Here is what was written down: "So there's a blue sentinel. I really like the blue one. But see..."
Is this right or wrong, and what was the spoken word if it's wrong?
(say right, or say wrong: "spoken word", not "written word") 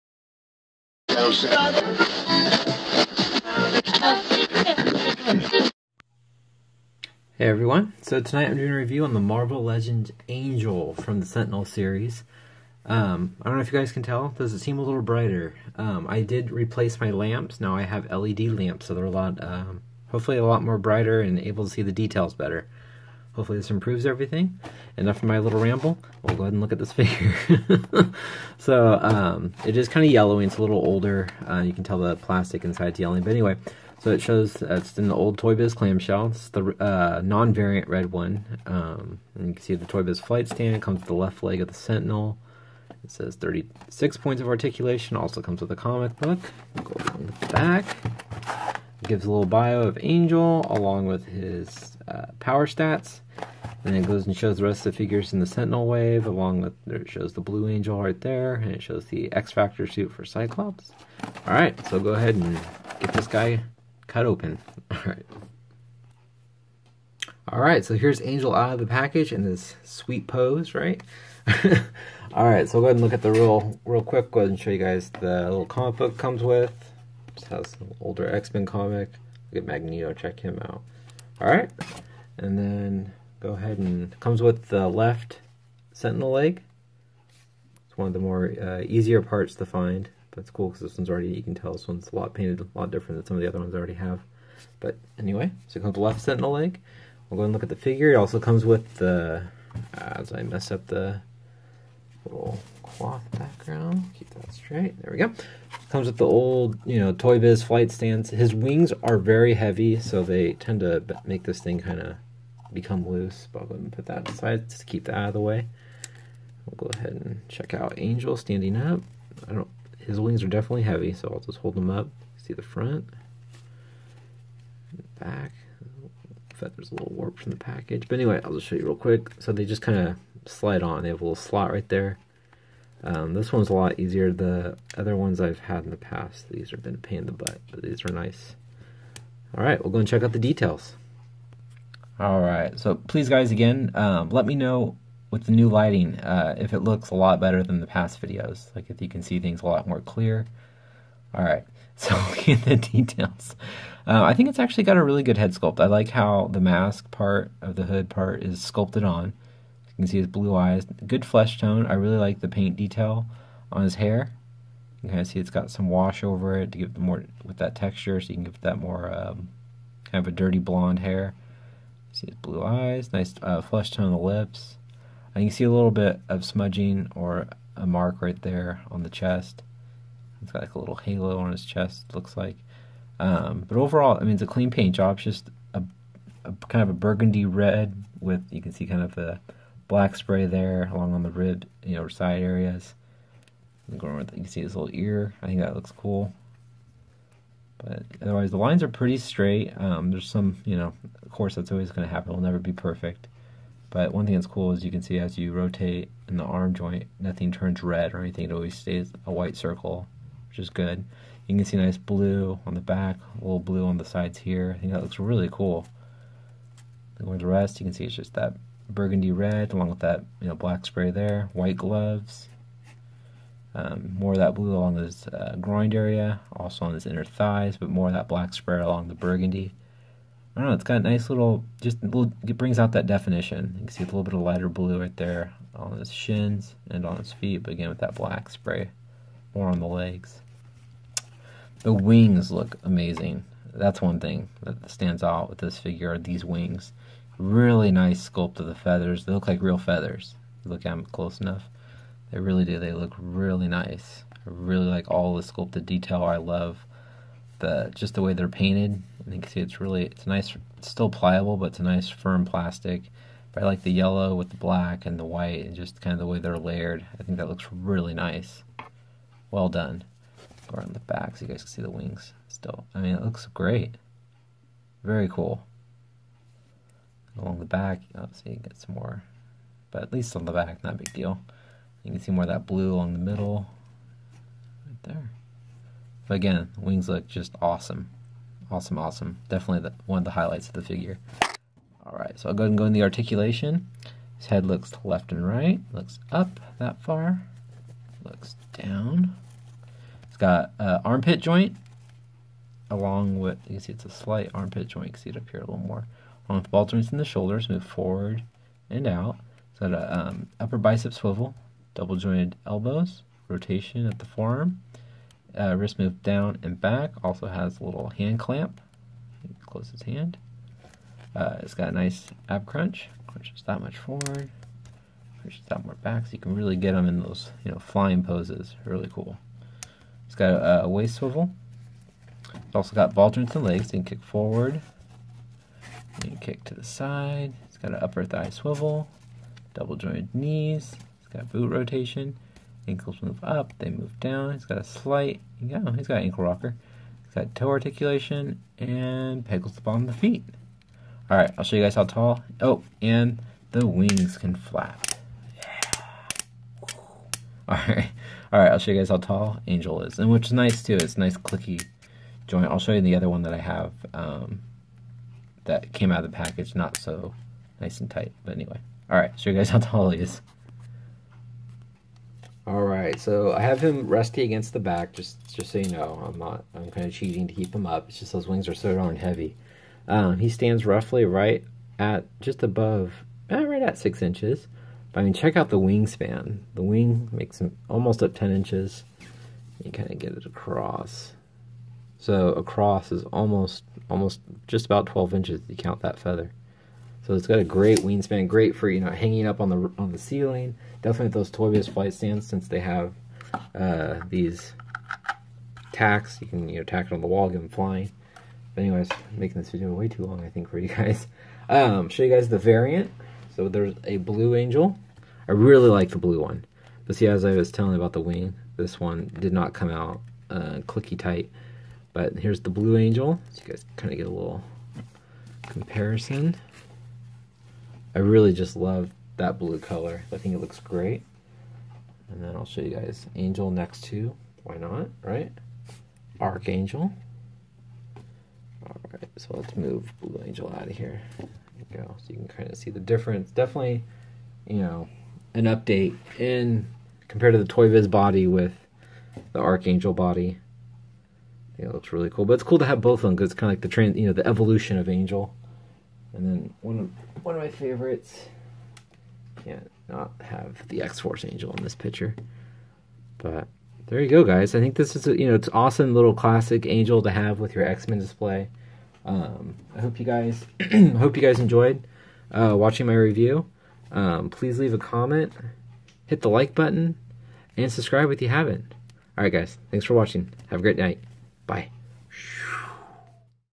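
wrong: "angel", not "sentinel".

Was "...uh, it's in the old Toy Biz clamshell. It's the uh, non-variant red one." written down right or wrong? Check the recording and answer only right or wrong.
right.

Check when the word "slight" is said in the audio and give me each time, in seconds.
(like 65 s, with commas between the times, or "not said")
304 s, 344 s.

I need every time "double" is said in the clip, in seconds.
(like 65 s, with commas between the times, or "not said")
311 s, 339 s.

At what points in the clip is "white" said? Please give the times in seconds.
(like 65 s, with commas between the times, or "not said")
209 s, 221 s, 265 s.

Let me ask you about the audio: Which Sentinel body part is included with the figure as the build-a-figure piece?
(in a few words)
Left leg.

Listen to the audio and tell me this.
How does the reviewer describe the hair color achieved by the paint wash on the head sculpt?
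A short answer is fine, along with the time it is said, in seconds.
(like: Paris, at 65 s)
Dirty blonde, at 170 s.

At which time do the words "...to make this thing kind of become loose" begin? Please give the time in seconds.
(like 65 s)
110 s.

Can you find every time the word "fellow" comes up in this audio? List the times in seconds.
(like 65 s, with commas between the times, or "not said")
not said.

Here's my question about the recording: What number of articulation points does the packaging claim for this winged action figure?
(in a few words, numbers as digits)
36.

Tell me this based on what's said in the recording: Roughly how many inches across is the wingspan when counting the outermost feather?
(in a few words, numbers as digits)
12 inches.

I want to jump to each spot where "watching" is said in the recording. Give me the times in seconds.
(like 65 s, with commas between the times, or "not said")
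472 s, 480 s.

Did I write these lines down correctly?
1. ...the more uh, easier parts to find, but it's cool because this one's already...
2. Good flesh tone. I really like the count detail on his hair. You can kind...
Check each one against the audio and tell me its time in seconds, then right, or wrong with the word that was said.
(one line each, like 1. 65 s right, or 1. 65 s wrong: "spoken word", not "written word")
1. 88 s right
2. 161 s wrong: "paint", not "count".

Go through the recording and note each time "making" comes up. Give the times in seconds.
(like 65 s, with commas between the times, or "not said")
409 s.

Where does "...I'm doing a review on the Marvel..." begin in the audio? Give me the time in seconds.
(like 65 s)
8 s.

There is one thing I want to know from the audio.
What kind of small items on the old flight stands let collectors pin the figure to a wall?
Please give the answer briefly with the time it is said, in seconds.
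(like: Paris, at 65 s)
Tacks, at 405 s.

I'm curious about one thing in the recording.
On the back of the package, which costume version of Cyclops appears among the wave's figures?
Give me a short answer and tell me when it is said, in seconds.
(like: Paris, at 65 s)
X Factor, at 59 s.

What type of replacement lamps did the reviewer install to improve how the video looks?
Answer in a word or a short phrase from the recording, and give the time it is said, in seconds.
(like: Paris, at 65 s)
LED lamps, at 18 s.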